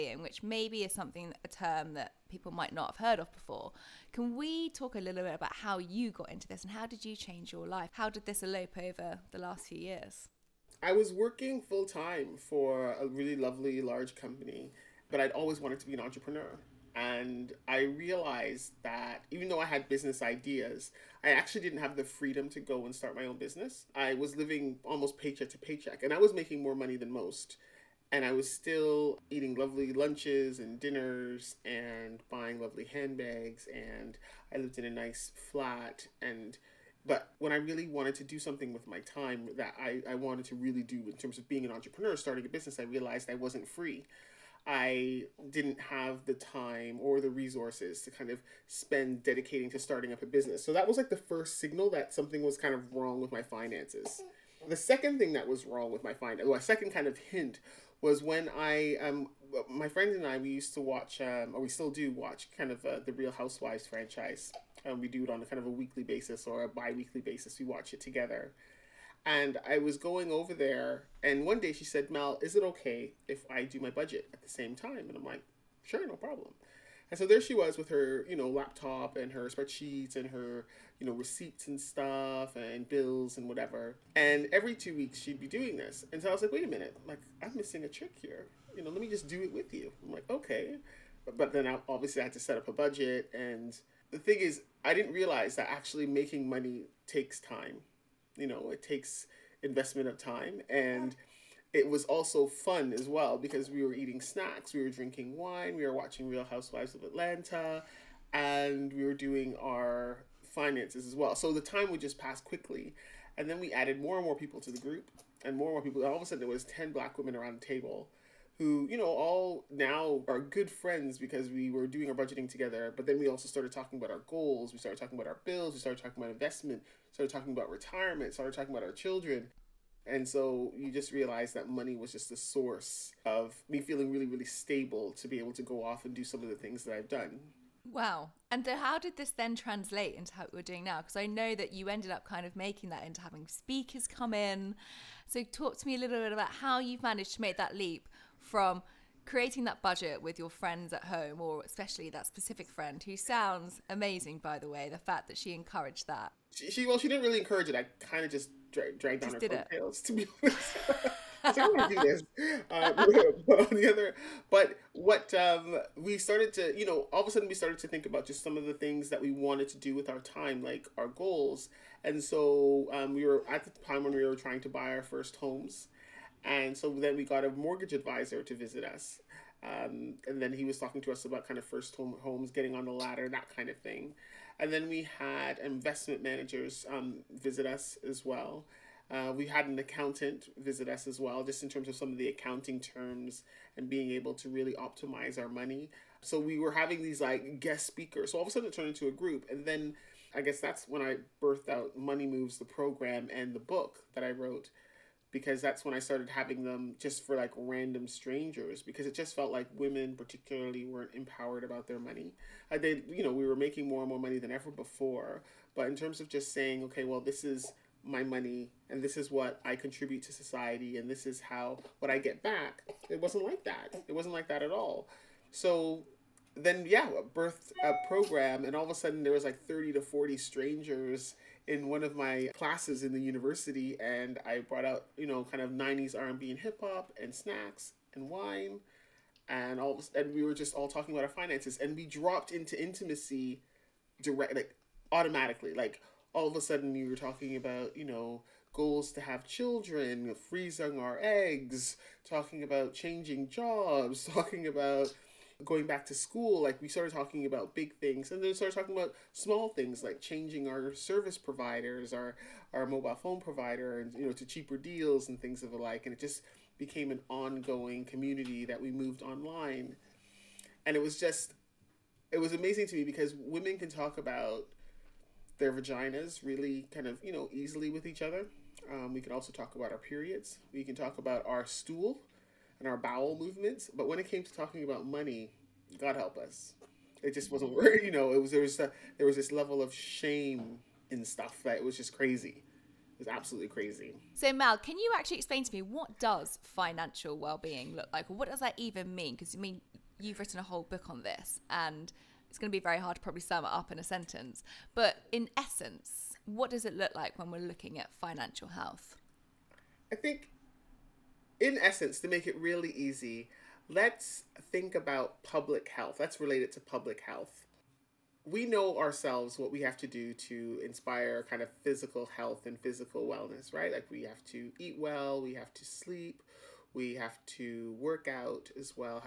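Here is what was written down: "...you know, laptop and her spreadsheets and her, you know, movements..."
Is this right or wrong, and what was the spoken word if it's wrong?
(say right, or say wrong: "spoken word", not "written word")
wrong: "receipts", not "movements".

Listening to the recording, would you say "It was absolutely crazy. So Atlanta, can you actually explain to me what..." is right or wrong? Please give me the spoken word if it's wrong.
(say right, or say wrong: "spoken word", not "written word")
wrong: "Mal", not "Atlanta".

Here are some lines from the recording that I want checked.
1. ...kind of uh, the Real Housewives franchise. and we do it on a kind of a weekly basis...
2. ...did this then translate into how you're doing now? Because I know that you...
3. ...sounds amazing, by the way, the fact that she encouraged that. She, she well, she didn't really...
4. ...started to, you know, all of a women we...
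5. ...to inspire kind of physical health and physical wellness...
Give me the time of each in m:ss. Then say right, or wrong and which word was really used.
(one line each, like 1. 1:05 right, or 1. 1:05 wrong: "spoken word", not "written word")
1. 1:02 right
2. 2:18 right
3. 2:33 right
4. 2:46 wrong: "sudden", not "women"
5. 5:20 right.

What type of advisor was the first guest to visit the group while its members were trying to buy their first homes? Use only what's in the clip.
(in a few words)
mortgage advisor.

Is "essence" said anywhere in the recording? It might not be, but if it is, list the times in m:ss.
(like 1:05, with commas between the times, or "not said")
5:05, 5:11.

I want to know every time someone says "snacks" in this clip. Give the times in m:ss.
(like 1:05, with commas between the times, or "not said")
1:44, 3:57.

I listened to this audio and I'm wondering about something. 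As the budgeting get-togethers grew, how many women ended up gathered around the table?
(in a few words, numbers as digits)
10.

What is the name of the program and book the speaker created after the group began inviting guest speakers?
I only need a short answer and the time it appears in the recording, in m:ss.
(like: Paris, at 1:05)
Money Moves, at 3:21.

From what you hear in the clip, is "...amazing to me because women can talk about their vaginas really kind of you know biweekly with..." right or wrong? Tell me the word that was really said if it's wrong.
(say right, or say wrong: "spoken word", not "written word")
wrong: "easily", not "biweekly".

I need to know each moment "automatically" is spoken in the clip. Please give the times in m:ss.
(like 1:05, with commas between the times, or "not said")
4:05.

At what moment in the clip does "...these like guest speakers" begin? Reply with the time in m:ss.
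3:17.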